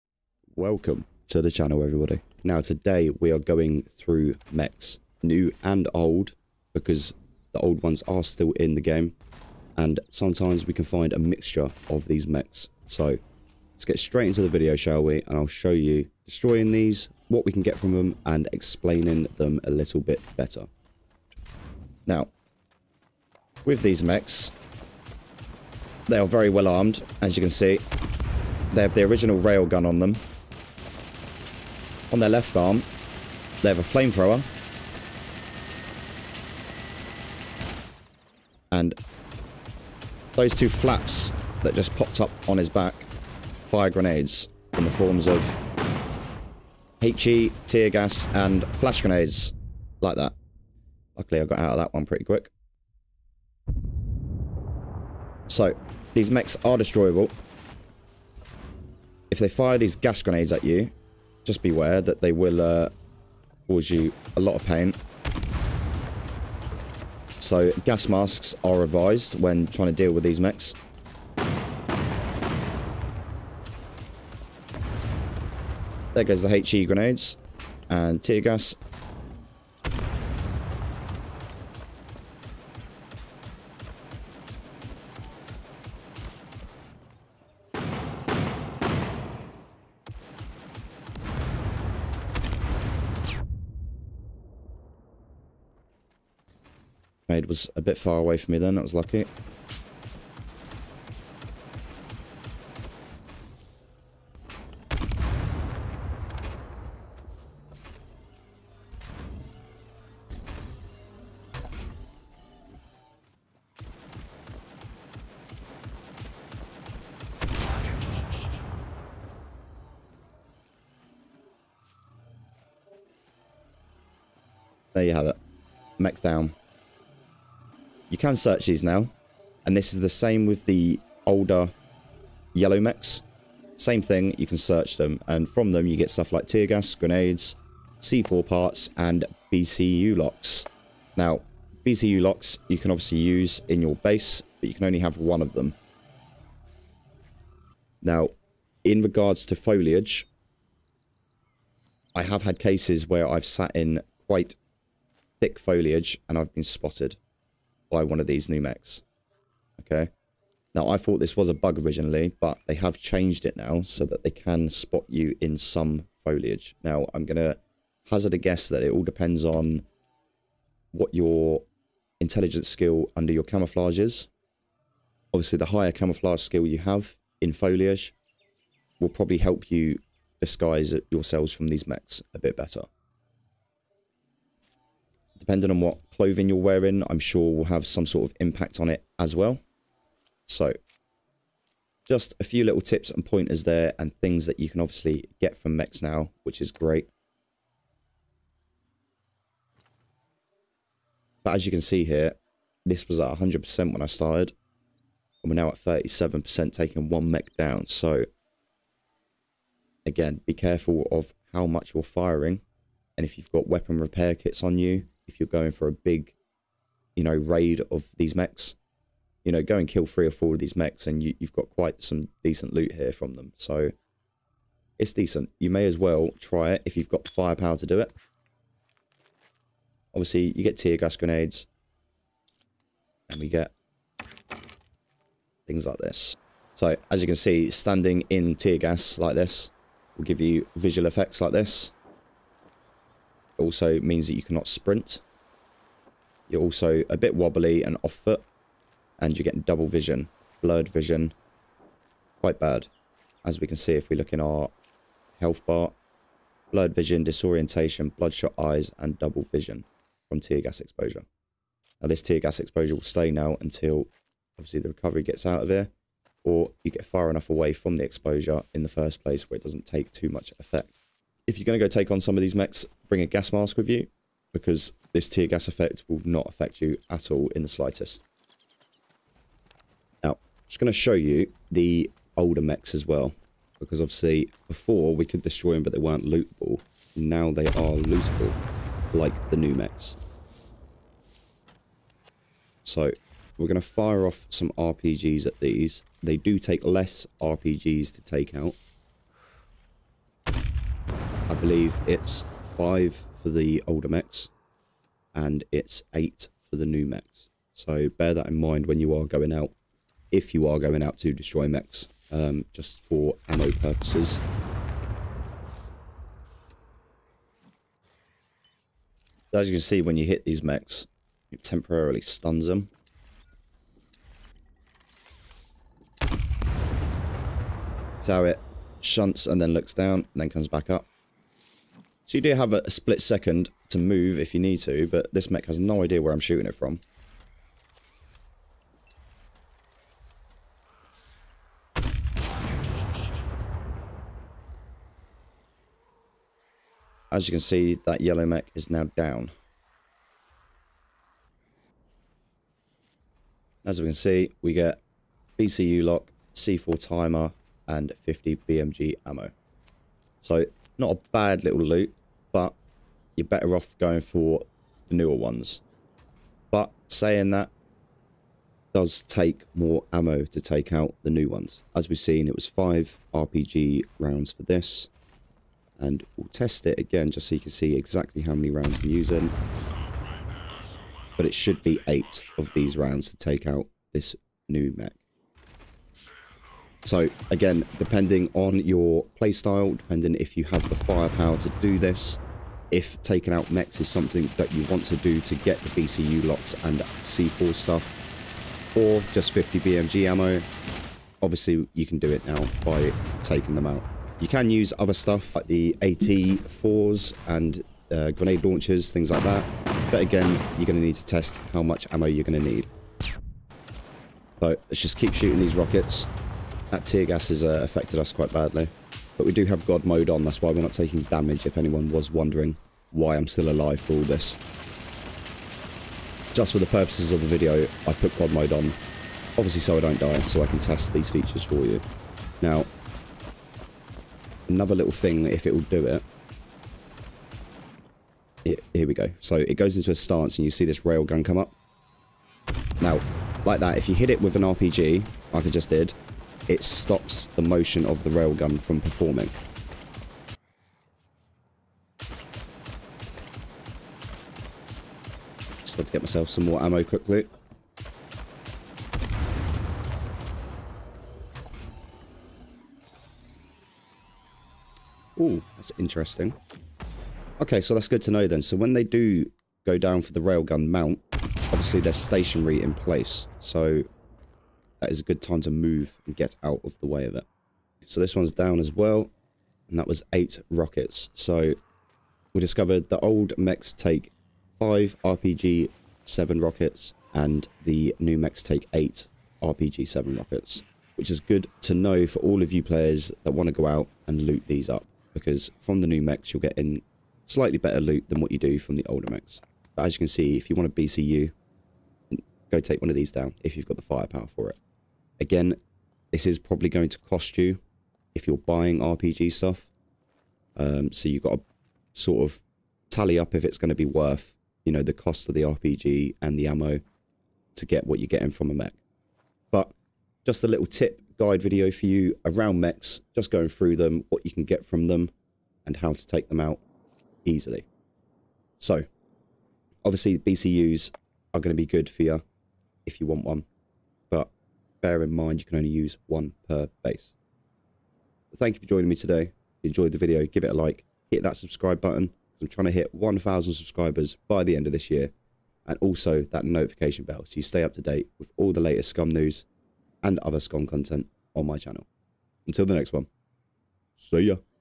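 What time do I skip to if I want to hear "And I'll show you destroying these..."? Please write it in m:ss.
0:15.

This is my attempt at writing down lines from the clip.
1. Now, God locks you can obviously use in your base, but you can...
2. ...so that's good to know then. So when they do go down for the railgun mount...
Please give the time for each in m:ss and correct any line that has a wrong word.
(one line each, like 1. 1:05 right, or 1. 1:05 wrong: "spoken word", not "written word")
1. 2:21 wrong: "BCU", not "God"
2. 7:47 right.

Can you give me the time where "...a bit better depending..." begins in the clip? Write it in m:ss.
3:02.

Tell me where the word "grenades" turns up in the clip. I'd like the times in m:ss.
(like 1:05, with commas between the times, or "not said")
0:43, 0:49, 1:00, 1:16, 2:16, 3:51, 6:48.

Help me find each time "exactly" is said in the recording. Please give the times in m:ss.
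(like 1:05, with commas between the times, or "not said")
6:17.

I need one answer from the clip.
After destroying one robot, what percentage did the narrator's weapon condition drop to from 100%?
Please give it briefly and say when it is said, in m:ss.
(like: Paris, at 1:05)
37%, at 3:25.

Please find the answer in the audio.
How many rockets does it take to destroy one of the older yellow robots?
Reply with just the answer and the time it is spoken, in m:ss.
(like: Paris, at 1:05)
5, at 5:02.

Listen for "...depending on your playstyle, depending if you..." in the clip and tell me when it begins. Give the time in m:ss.
6:27.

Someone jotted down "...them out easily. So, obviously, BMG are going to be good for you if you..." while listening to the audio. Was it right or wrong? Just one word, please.
wrong.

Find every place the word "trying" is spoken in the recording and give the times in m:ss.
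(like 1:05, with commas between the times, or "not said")
1:09, 9:02.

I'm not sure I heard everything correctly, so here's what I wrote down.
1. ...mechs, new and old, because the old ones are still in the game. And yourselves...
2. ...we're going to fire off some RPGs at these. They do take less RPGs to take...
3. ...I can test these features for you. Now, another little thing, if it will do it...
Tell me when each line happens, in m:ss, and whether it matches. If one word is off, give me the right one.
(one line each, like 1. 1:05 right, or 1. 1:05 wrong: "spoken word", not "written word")
1. 0:04 wrong: "sometimes", not "yourselves"
2. 4:53 right
3. 7:10 right.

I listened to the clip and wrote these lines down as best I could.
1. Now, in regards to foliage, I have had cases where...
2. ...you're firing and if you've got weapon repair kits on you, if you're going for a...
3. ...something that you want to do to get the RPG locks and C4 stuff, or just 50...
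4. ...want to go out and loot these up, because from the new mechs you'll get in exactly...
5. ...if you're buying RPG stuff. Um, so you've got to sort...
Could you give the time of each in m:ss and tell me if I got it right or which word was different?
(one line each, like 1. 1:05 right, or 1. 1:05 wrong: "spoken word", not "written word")
1. 2:28 right
2. 3:31 right
3. 6:34 wrong: "BCU", not "RPG"
4. 8:13 wrong: "slightly", not "exactly"
5. 8:28 right.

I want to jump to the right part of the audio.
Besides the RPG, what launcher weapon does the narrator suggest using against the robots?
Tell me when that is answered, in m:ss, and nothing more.
6:46.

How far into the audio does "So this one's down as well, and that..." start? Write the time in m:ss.
7:58.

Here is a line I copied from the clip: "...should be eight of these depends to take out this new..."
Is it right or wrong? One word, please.
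wrong.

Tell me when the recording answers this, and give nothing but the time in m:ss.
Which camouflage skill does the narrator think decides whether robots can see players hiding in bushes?
2:52.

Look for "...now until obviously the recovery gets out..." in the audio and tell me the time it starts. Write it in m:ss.
4:23.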